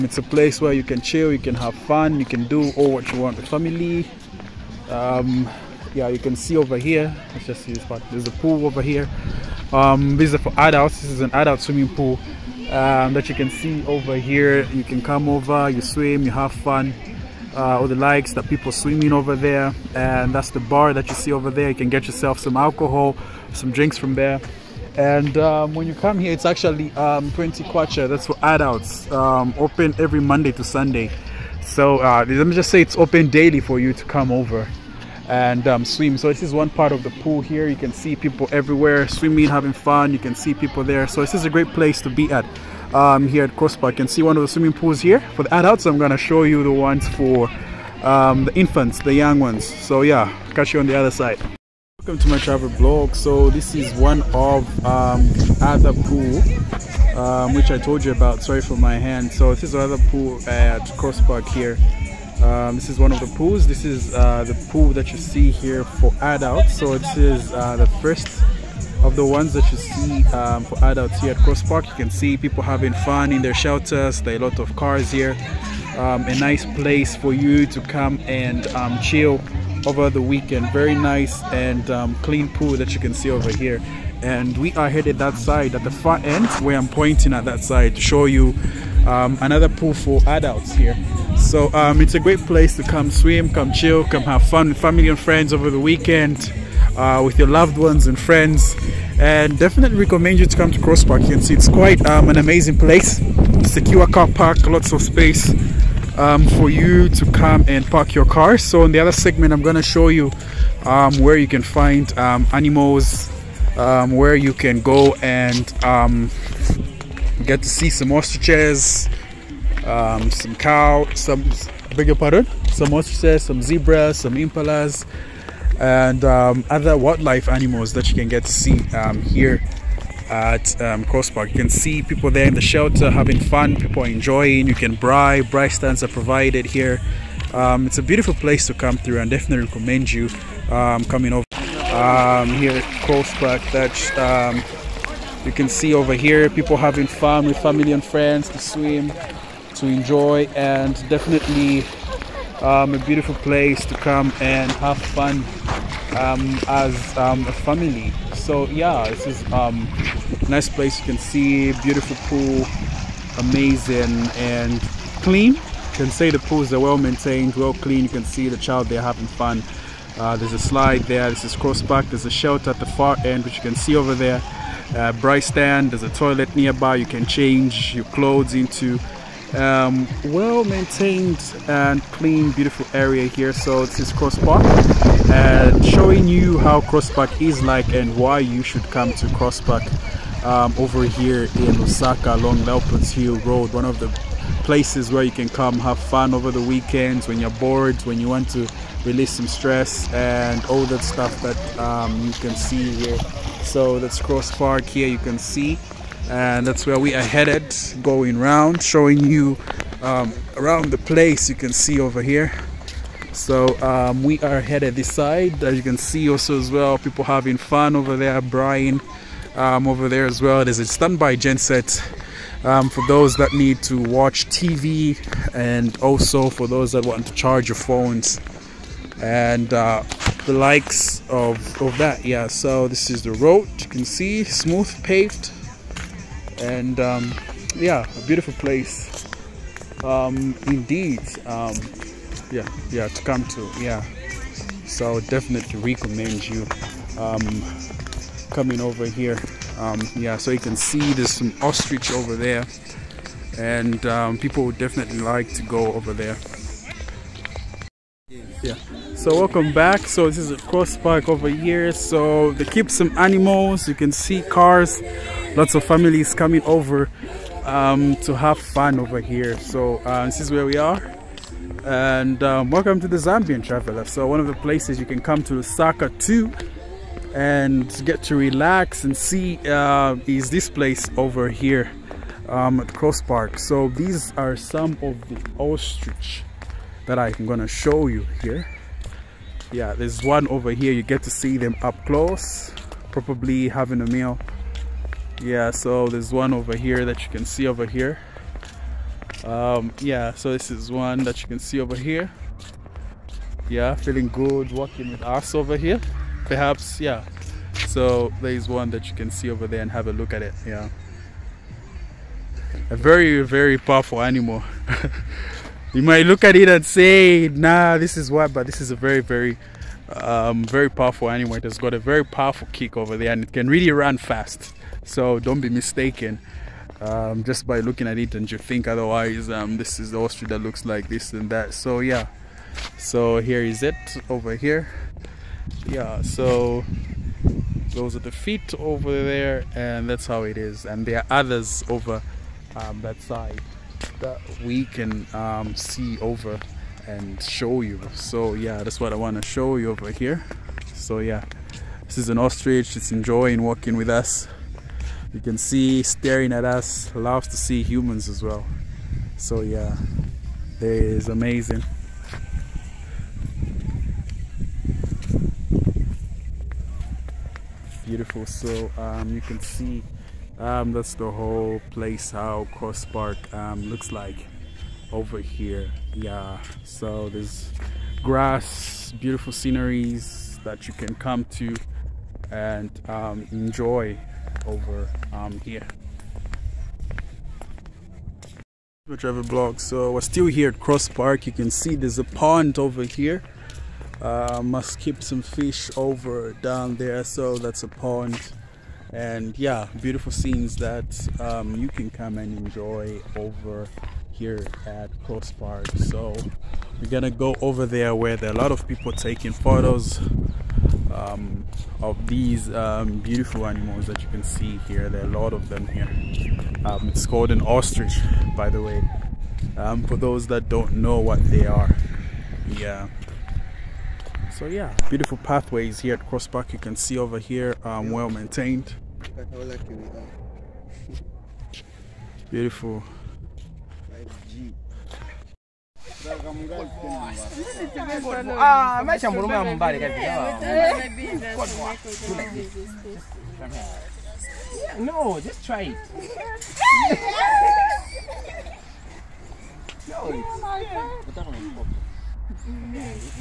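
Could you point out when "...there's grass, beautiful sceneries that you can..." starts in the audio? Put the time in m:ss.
6:17.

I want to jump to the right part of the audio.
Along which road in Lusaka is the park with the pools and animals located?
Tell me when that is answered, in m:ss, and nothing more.
3:12.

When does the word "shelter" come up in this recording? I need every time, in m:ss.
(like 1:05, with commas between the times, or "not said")
1:13, 2:12, 2:52.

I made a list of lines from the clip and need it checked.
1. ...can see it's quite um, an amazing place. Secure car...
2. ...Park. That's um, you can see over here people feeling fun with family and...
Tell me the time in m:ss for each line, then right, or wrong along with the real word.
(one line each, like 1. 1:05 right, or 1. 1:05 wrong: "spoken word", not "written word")
1. 1:41 right
2. 2:23 wrong: "having", not "feeling".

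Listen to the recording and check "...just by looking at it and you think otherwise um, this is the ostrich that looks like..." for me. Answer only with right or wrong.
right.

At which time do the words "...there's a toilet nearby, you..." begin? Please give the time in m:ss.
2:55.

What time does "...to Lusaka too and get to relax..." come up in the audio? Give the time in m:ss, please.
4:35.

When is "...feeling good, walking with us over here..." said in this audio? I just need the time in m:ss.
5:03.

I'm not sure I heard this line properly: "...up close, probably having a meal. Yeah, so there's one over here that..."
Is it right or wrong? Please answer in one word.
right.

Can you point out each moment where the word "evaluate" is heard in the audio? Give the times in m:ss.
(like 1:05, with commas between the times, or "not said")
not said.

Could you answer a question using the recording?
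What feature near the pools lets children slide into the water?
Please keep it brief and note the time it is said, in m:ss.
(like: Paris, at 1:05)
a slide, at 2:50.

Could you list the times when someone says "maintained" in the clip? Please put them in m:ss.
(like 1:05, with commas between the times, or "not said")
2:46, 3:00, 7:08.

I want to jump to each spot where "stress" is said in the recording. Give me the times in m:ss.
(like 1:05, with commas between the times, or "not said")
3:19.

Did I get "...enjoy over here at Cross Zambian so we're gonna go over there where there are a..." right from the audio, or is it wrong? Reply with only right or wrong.
wrong.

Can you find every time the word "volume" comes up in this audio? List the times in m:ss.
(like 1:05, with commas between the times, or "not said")
not said.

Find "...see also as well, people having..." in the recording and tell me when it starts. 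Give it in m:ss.
3:35.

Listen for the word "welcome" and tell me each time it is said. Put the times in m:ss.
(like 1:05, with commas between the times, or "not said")
0:51, 4:19, 4:32.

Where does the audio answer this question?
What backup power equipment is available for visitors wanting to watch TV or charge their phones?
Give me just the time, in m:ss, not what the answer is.
3:40.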